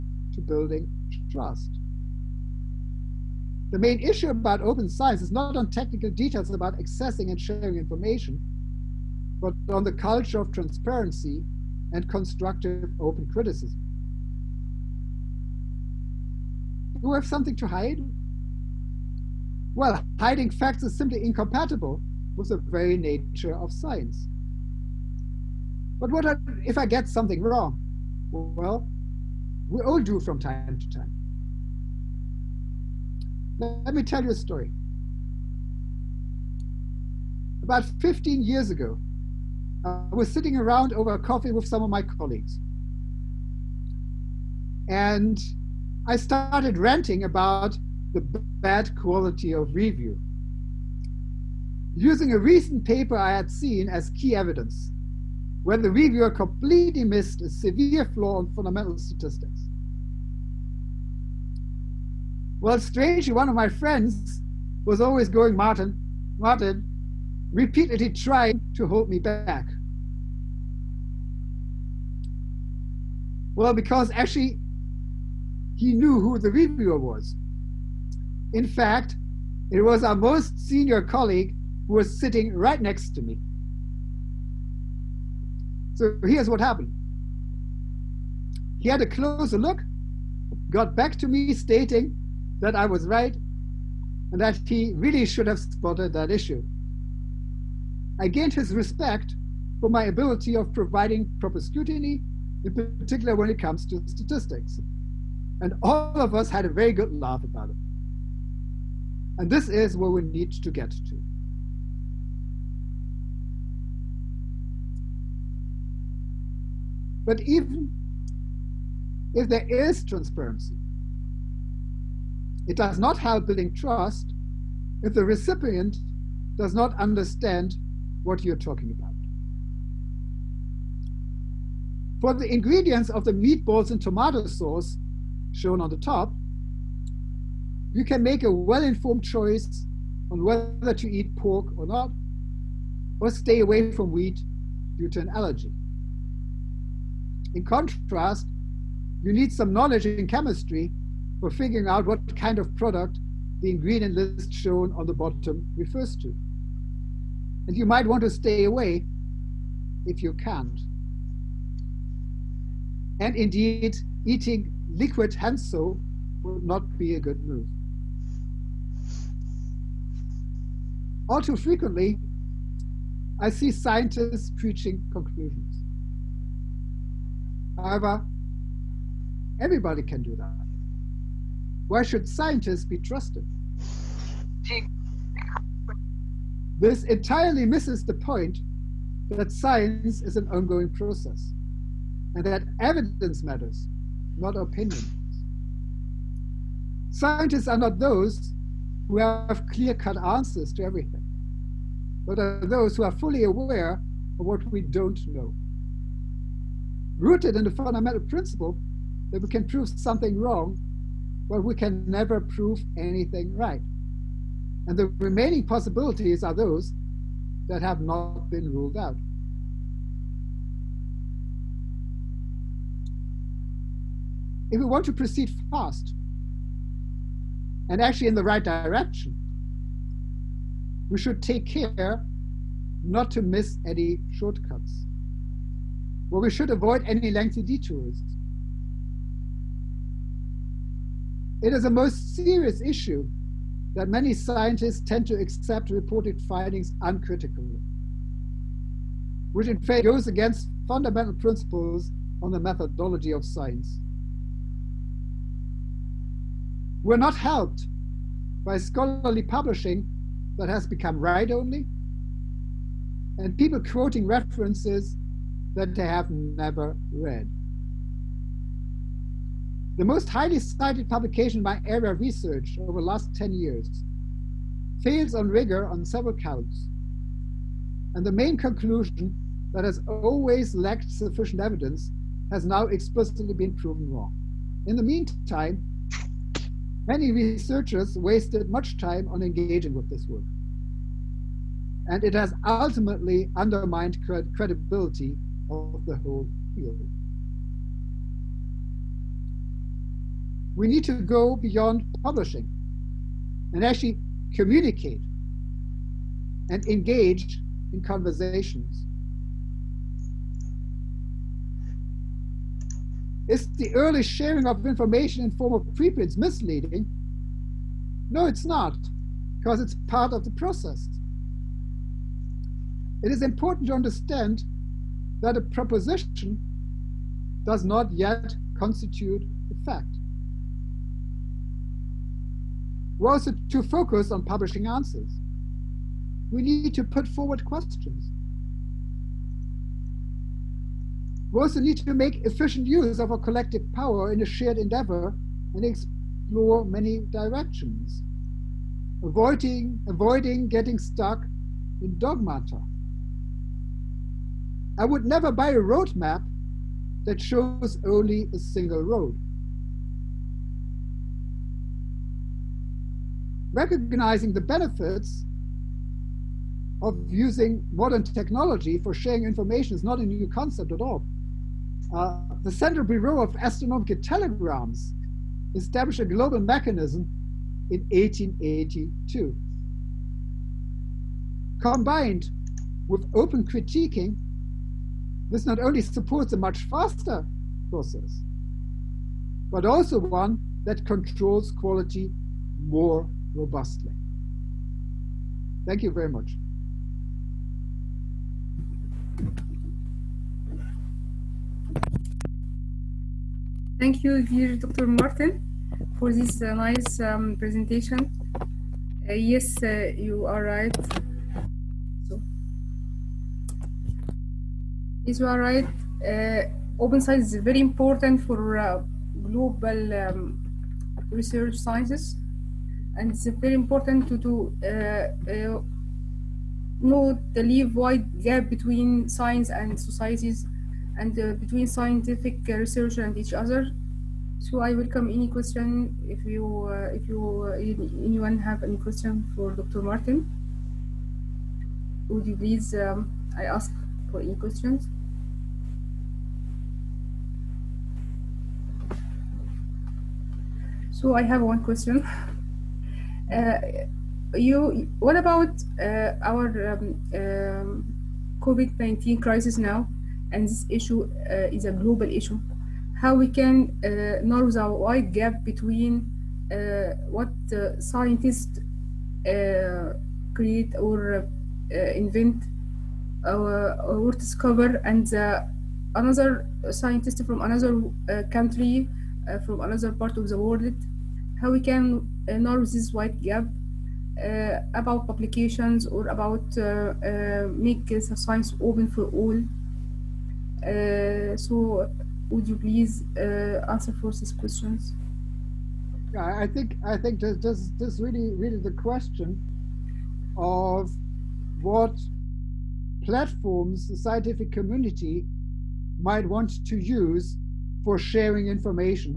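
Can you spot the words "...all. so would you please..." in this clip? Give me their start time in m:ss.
8:09.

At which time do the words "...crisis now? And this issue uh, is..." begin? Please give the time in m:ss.
7:39.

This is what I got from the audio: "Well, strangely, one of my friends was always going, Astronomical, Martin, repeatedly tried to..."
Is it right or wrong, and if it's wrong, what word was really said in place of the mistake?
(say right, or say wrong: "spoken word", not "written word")
wrong: "Martin", not "Astronomical".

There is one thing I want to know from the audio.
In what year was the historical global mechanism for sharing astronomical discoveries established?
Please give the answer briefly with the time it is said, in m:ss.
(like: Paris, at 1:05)
1882, at 6:18.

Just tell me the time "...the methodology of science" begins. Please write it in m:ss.
4:12.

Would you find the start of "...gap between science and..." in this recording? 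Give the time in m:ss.
7:08.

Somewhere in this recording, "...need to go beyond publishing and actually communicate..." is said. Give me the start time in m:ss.
5:00.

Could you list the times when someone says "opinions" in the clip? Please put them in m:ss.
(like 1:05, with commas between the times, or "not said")
3:14.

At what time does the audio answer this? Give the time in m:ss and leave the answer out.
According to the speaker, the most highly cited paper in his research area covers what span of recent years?
4:32.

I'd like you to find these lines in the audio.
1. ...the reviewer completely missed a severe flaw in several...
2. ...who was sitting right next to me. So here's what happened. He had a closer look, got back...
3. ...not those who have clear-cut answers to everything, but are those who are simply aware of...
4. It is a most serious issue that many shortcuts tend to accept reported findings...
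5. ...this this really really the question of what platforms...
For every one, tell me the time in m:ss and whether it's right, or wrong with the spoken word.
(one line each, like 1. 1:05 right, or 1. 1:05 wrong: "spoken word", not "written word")
1. 0:55 wrong: "fundamental", not "several"
2. 1:21 right
3. 3:17 wrong: "fully", not "simply"
4. 4:01 wrong: "scientists", not "shortcuts"
5. 8:17 right.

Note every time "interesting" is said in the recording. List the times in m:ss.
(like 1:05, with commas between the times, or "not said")
not said.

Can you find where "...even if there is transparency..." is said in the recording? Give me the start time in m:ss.
1:57.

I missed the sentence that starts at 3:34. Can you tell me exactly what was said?
And the remaining possibilities are those that have not been ruled out.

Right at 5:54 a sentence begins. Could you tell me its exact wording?
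I would never buy a road map that shows only a single road.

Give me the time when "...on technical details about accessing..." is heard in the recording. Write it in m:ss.
0:05.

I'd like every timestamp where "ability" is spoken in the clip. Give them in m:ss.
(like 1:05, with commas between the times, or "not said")
1:40.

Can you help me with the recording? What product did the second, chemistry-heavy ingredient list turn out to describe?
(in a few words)
liquid hand soap.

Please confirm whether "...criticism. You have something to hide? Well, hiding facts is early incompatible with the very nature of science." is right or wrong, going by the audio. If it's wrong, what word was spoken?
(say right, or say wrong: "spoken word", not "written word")
wrong: "simply", not "early".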